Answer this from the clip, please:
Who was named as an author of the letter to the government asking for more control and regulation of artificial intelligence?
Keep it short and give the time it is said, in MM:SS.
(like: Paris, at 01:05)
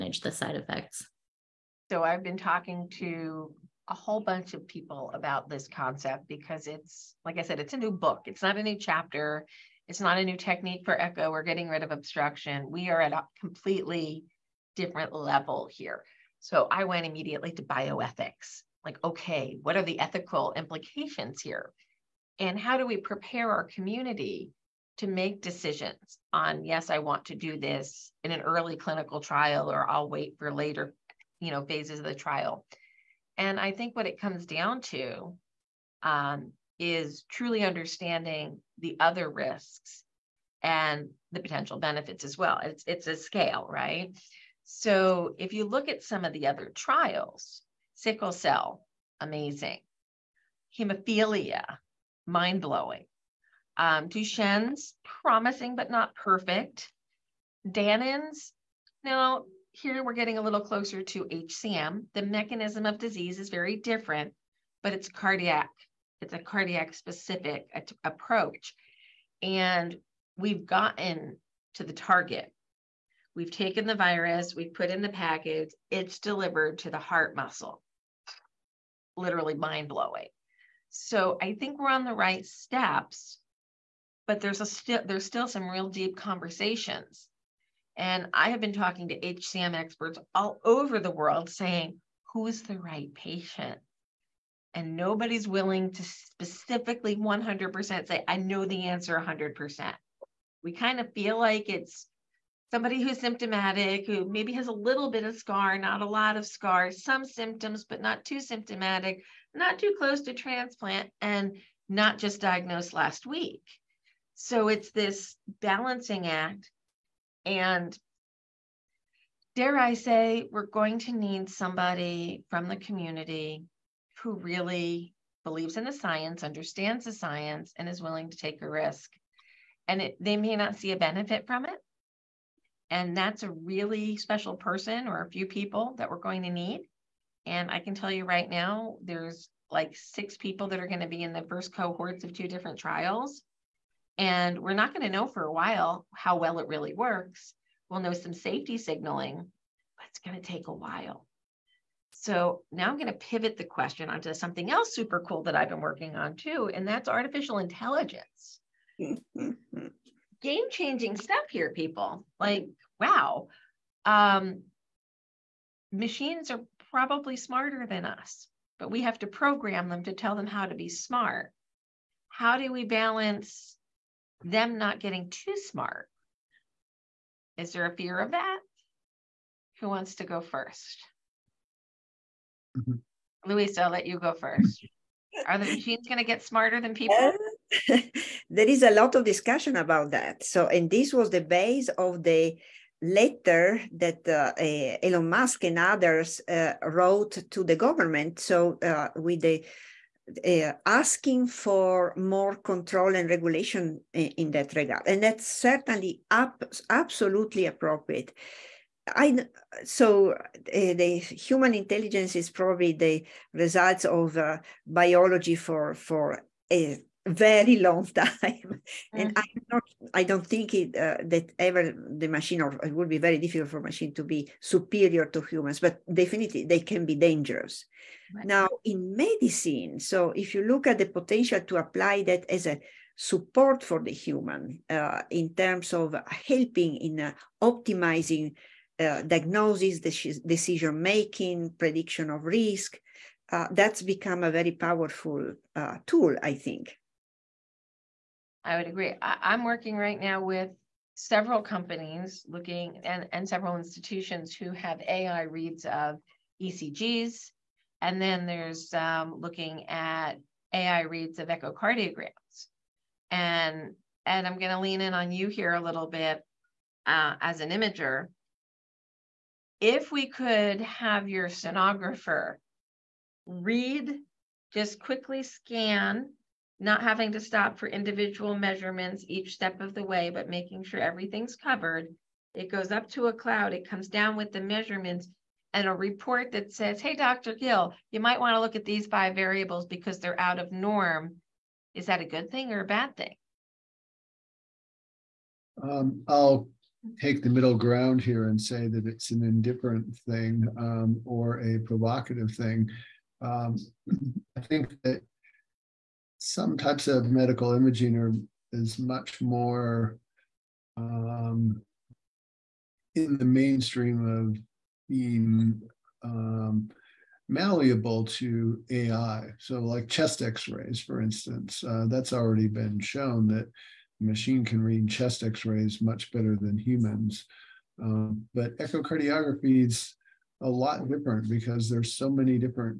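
Elon Musk, at 03:15.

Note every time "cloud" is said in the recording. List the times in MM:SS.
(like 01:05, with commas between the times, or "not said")
04:43.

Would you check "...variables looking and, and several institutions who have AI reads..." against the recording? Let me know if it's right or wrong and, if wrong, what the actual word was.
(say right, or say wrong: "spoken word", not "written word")
wrong: "companies", not "variables".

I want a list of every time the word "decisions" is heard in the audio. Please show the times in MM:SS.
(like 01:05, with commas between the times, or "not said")
00:25, 04:00.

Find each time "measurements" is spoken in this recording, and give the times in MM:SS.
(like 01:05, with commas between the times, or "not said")
04:38, 04:44.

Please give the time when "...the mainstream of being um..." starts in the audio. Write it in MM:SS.
05:13.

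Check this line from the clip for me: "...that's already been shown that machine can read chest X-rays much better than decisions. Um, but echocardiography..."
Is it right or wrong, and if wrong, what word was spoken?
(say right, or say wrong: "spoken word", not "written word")
wrong: "humans", not "decisions".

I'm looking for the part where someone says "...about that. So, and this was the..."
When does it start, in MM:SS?
03:09.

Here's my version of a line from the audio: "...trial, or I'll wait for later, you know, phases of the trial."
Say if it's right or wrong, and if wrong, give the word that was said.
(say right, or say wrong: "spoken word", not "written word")
right.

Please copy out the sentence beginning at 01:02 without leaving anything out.
The mechanism of disease is very different, but it's cardiac.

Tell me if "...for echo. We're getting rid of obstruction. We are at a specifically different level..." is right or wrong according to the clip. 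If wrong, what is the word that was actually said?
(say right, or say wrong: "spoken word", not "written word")
wrong: "completely", not "specifically".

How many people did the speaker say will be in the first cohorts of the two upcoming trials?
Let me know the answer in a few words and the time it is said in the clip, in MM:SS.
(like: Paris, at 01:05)
6, at 02:19.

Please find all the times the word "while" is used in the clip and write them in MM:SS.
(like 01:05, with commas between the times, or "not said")
02:25, 02:30.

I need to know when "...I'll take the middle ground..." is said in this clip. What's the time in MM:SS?
04:56.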